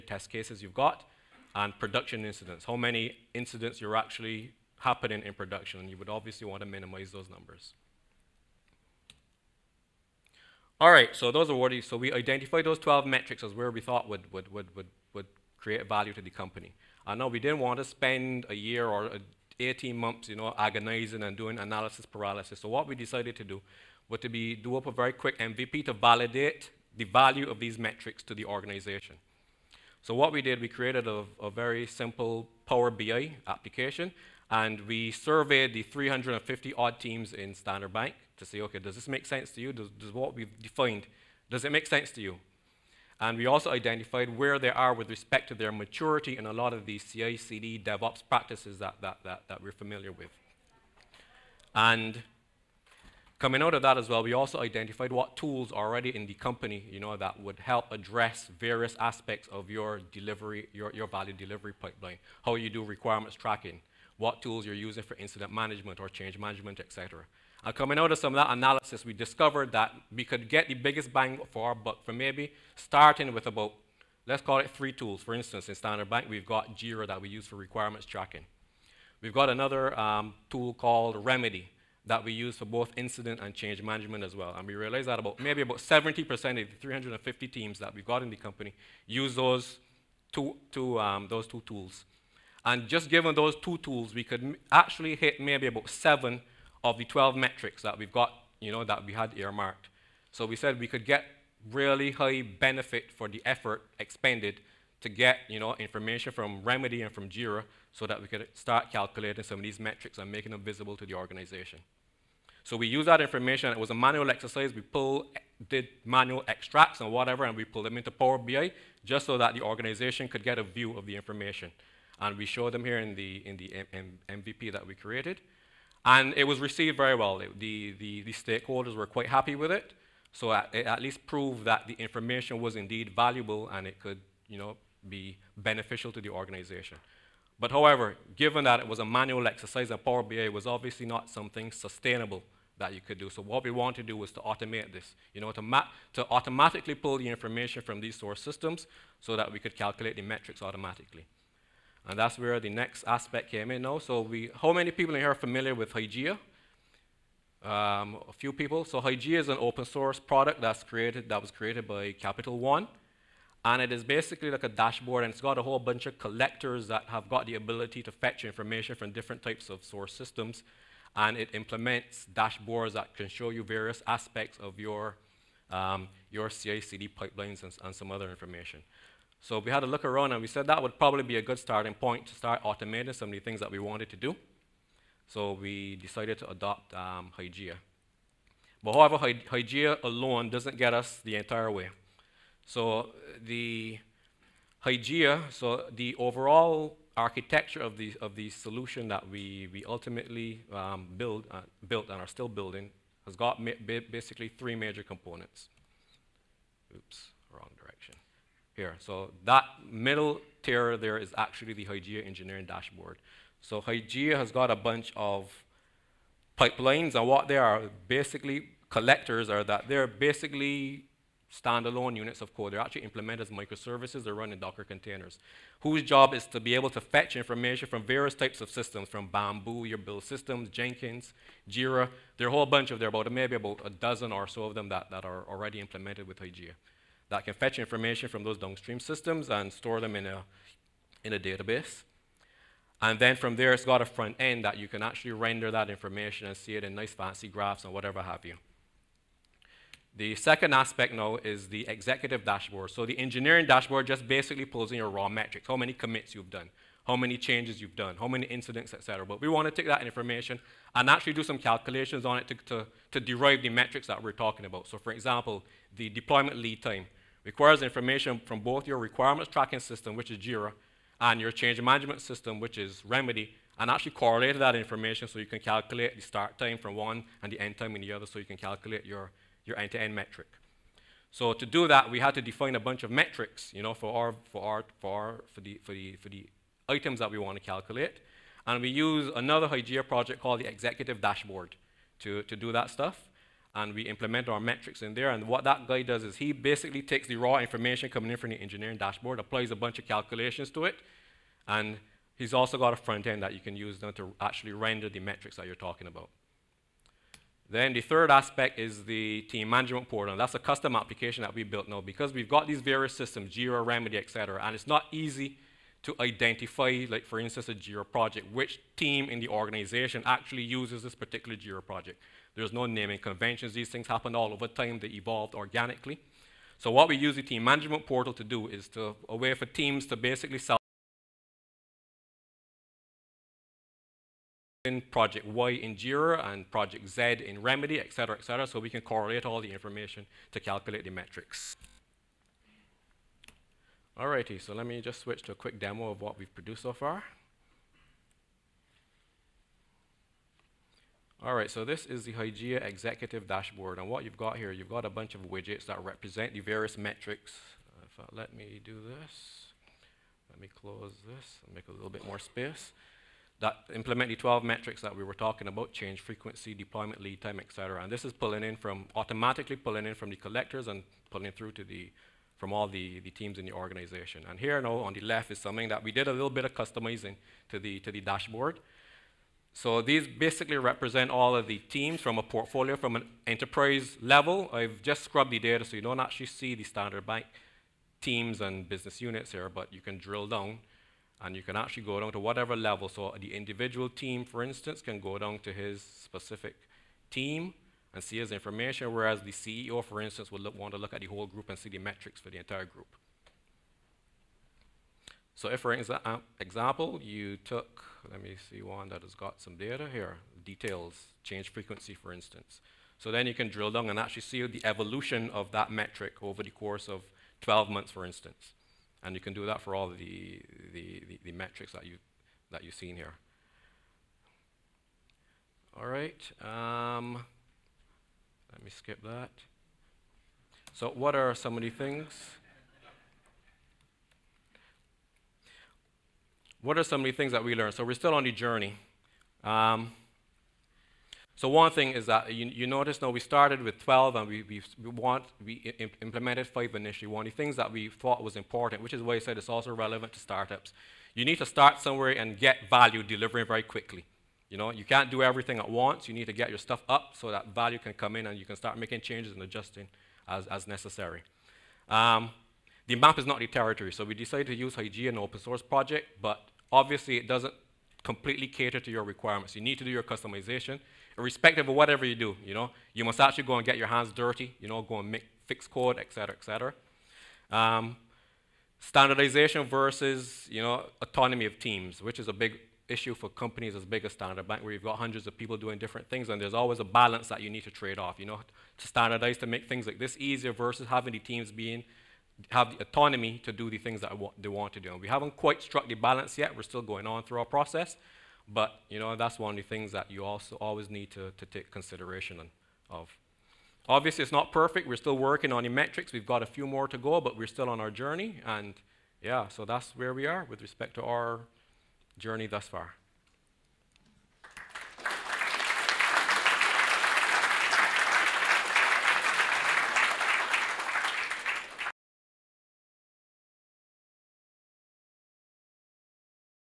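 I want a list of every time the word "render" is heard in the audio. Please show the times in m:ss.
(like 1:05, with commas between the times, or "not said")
4:05, 5:04.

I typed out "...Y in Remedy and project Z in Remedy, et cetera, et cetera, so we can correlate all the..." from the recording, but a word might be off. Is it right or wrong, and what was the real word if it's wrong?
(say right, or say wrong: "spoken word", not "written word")
wrong: "JIRA", not "Remedy".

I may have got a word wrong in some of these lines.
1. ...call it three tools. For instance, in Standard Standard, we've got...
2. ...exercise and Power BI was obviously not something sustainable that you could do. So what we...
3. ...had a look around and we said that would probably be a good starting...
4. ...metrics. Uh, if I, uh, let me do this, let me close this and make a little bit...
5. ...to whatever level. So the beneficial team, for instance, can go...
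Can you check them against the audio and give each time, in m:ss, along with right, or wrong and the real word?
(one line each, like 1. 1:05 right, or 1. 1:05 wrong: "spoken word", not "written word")
1. 1:14 wrong: "Bank", not "Standard"
2. 2:19 right
3. 2:59 right
4. 5:56 right
5. 6:32 wrong: "individual", not "beneficial".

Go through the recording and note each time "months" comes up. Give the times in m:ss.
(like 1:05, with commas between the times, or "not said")
0:19, 6:57.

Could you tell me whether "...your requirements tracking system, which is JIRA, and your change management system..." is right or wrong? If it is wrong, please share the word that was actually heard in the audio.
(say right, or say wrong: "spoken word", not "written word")
right.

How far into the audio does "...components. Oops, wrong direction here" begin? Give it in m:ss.
3:25.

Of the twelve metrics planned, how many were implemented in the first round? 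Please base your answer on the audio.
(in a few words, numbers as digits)
5.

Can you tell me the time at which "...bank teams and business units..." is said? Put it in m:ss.
6:27.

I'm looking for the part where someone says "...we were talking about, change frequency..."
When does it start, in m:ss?
6:05.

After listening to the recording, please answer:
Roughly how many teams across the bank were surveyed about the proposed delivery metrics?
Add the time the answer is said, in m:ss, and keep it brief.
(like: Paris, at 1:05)
350, at 0:35.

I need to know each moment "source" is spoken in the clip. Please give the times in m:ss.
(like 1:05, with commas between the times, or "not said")
2:28, 2:39, 2:49, 7:45.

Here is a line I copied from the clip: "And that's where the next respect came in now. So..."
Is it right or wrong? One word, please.
wrong.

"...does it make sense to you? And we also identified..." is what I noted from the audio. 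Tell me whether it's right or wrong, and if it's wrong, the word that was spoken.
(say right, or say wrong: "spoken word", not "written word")
right.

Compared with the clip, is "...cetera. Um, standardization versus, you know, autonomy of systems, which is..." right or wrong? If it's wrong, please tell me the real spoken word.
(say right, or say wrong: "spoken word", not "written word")
wrong: "teams", not "systems".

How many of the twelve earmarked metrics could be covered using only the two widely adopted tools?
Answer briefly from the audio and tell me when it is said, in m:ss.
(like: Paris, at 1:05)
7, at 1:35.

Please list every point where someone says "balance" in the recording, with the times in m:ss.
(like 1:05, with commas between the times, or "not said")
8:07, 8:16.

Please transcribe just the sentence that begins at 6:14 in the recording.
And here now on the left is something that we did a little bit of customizing to the, to the dashboard.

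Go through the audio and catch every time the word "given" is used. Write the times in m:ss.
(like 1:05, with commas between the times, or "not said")
1:33, 2:18.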